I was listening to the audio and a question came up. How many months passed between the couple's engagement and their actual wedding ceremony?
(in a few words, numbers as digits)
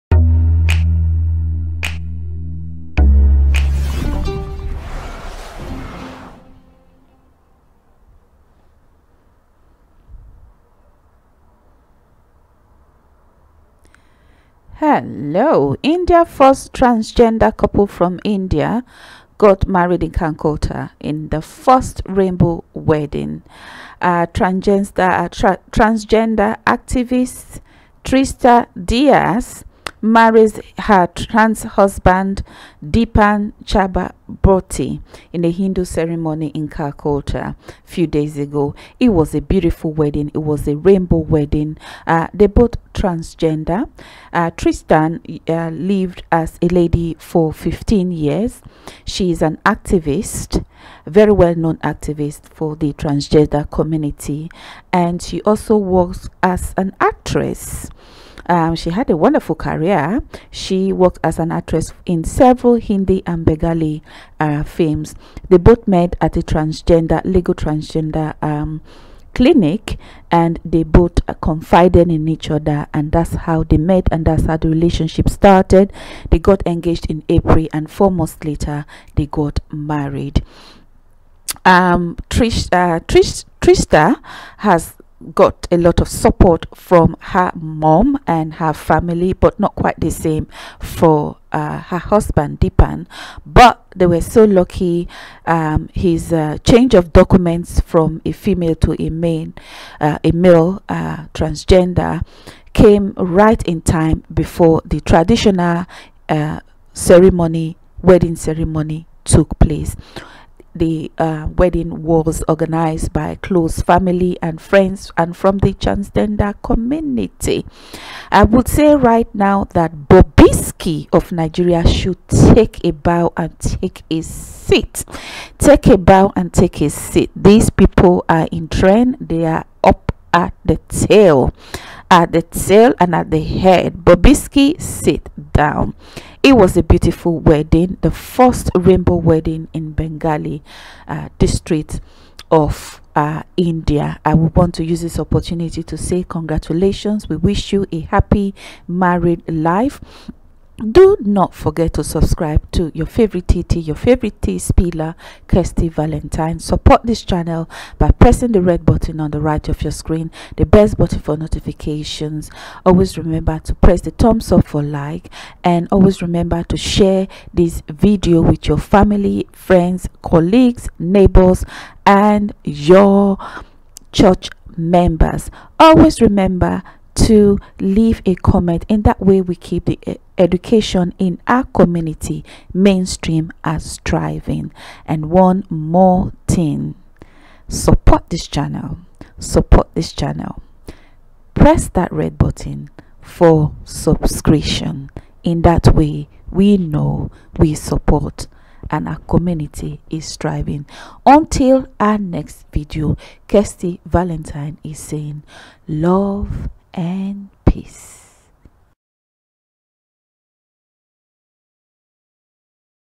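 4.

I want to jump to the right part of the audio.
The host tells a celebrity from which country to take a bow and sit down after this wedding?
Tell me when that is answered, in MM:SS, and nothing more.
02:01.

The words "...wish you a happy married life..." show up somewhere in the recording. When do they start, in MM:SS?
02:27.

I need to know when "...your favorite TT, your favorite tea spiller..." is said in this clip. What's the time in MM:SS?
02:32.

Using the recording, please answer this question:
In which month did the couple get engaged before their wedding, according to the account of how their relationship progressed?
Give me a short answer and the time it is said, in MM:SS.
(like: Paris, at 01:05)
April, at 01:17.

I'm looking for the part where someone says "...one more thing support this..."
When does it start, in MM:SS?
03:05.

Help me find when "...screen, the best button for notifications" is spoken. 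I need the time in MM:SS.
02:39.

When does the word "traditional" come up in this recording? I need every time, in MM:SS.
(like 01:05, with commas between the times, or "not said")
01:45.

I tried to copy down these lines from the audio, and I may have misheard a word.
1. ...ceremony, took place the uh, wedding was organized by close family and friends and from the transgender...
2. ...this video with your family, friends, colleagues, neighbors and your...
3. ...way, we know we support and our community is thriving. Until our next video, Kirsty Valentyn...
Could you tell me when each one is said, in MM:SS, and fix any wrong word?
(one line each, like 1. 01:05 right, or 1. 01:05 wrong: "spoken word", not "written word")
1. 01:48 right
2. 02:47 right
3. 03:15 right.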